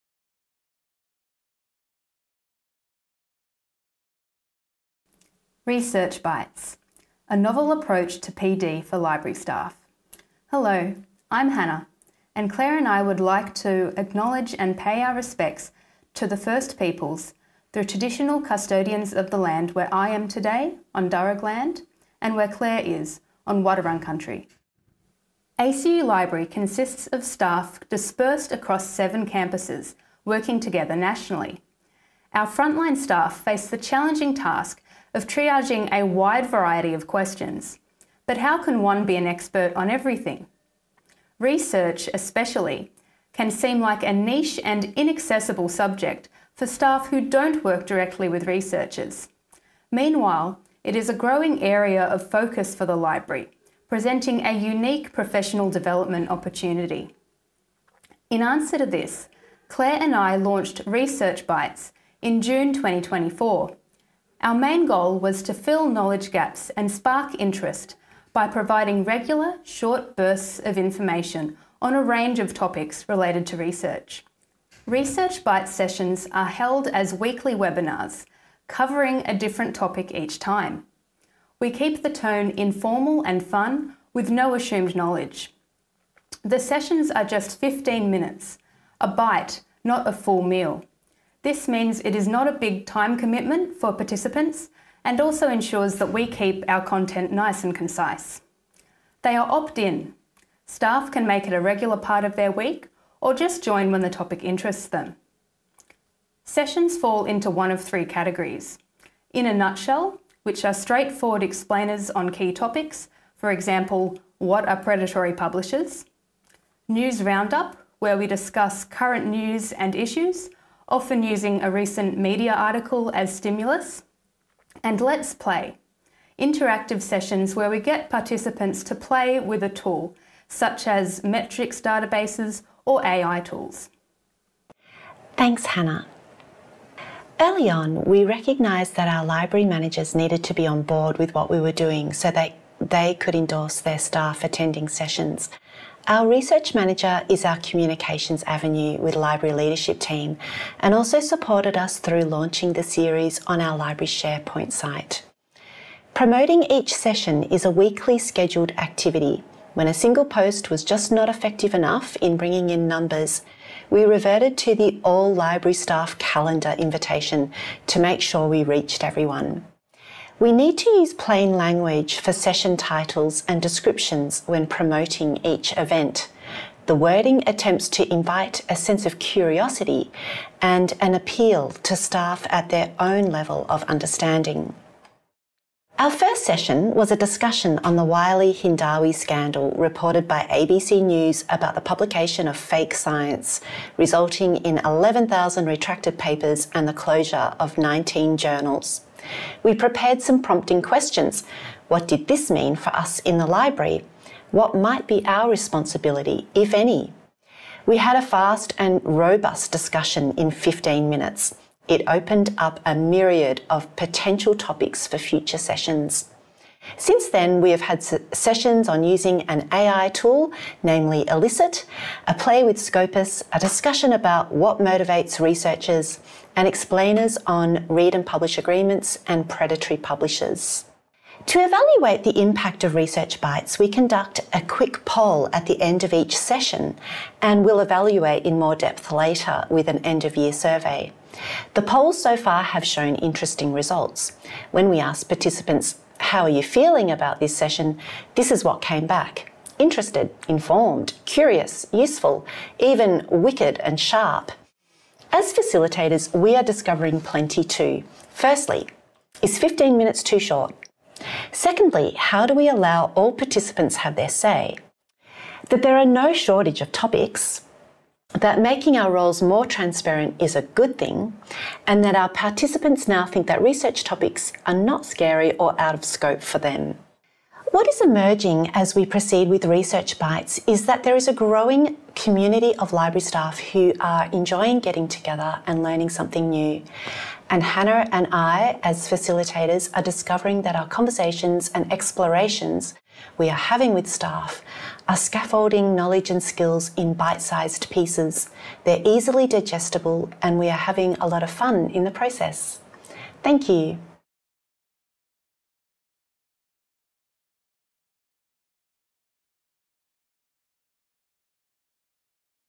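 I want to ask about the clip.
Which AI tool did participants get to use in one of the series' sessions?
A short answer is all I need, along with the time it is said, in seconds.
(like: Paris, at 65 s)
Elicit, at 221 s.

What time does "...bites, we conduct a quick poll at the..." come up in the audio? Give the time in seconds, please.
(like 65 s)
233 s.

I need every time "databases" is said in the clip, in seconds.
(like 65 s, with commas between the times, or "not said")
131 s.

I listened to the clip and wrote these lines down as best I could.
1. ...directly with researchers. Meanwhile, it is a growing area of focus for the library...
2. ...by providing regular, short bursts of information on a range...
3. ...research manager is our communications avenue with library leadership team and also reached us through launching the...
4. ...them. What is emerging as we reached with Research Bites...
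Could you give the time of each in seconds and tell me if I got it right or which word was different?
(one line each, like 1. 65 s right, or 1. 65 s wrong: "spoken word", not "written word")
1. 47 s right
2. 68 s right
3. 146 s wrong: "supported", not "reached"
4. 276 s wrong: "proceed", not "reached".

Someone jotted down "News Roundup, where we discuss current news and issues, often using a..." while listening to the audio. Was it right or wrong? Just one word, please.
right.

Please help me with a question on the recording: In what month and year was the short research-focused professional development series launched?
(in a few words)
June 2024.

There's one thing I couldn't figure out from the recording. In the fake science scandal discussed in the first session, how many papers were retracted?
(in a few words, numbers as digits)
11,000.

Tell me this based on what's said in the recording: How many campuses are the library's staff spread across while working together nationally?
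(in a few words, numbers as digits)
7.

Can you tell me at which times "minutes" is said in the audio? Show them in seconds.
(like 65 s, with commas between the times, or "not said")
88 s, 211 s, 259 s.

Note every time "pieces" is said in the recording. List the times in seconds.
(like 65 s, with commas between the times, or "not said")
297 s.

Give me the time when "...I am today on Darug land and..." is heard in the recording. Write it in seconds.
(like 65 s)
19 s.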